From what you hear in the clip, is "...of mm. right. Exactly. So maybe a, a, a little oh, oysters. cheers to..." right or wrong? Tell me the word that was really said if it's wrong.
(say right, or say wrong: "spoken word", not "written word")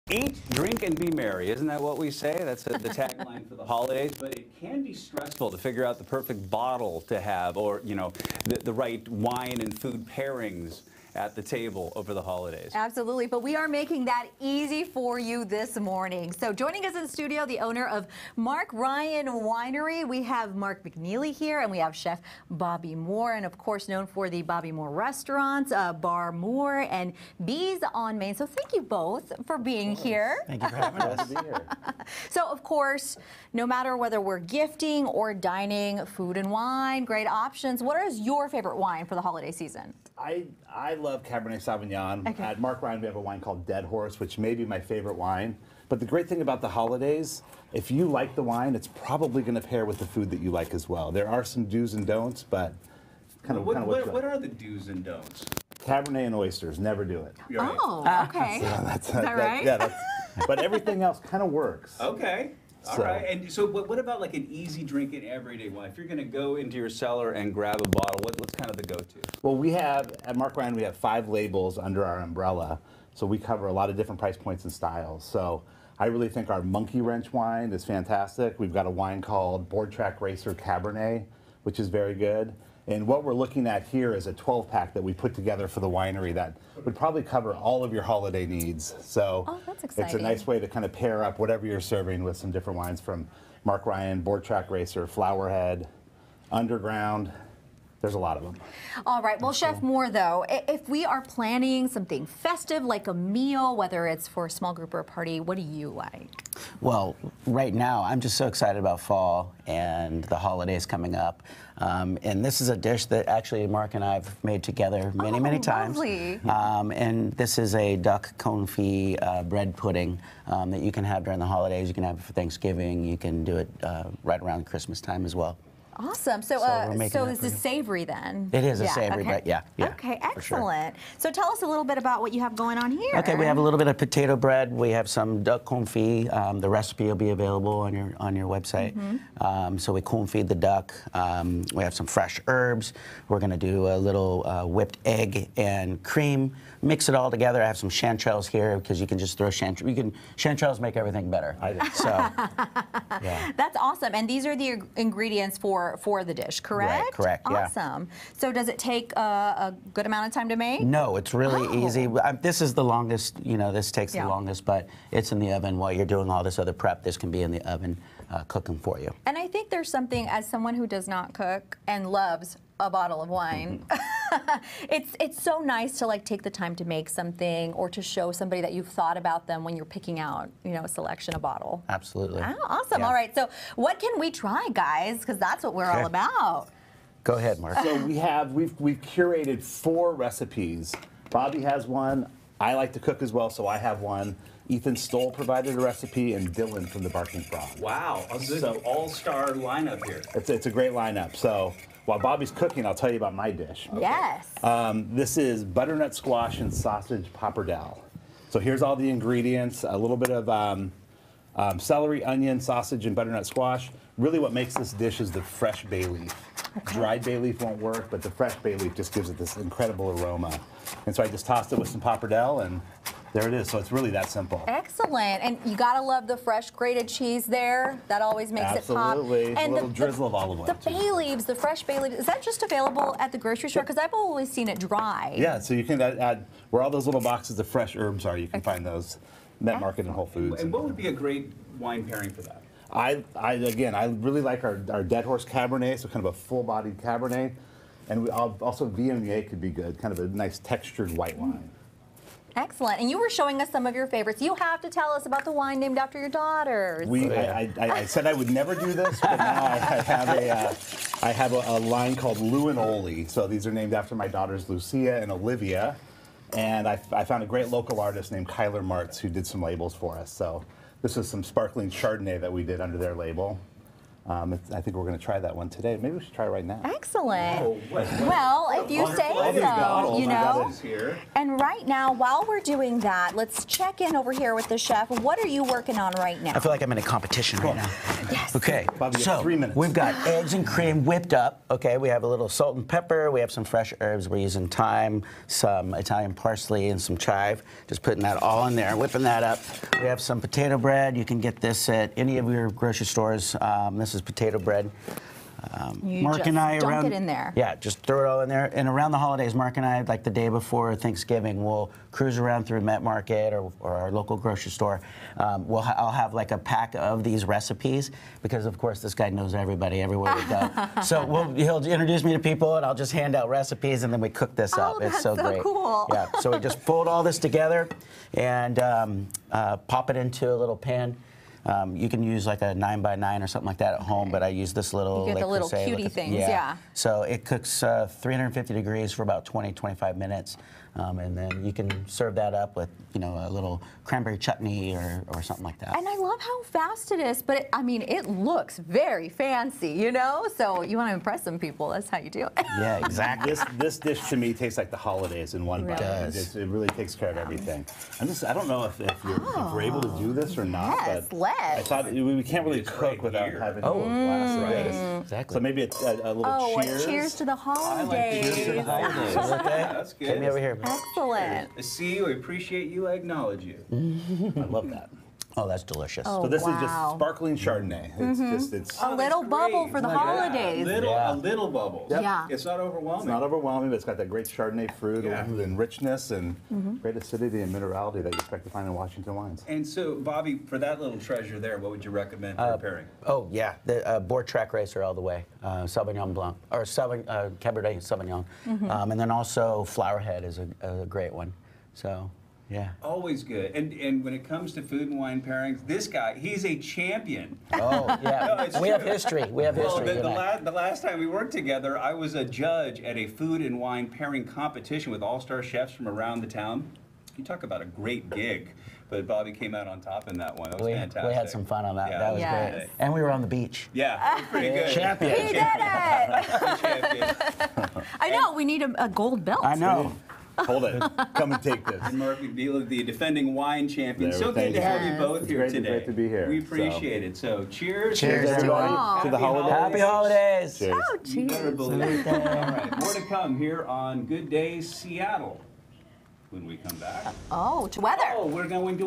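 wrong: "cheers", not "oysters".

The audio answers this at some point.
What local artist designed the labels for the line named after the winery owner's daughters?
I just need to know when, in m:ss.
4:28.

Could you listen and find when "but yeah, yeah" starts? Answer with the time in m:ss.
2:09.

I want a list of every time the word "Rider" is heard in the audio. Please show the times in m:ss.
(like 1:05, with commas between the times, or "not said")
not said.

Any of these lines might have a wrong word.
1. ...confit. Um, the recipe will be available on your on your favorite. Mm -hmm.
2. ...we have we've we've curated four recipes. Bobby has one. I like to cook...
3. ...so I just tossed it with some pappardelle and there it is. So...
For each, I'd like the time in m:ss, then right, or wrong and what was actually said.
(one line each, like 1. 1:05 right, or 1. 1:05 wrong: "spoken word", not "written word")
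1. 2:15 wrong: "website", not "favorite"
2. 3:08 right
3. 3:41 right.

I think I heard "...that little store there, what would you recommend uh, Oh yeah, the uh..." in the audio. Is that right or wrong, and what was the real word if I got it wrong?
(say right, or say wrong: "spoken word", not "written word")
wrong: "treasure", not "store".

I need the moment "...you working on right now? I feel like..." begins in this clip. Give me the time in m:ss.
4:45.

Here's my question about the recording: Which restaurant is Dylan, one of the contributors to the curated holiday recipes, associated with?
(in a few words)
Barking Frog.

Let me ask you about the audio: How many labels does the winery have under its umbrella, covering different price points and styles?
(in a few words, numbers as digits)
5.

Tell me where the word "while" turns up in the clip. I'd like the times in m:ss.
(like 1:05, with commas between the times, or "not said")
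2:45, 3:22, 4:42.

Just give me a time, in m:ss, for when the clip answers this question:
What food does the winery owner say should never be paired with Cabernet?
0:56.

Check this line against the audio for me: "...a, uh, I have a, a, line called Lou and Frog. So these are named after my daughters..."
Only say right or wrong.
wrong.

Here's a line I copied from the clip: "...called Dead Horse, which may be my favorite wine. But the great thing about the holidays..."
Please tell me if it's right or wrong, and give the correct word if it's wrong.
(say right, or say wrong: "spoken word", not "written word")
right.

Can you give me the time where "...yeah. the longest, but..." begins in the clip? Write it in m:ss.
2:44.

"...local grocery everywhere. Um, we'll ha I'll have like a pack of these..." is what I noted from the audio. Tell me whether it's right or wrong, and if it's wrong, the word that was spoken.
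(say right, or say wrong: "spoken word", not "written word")
wrong: "store", not "everywhere".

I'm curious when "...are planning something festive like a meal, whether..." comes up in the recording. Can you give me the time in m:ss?
1:41.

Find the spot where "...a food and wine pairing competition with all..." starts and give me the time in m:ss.
6:53.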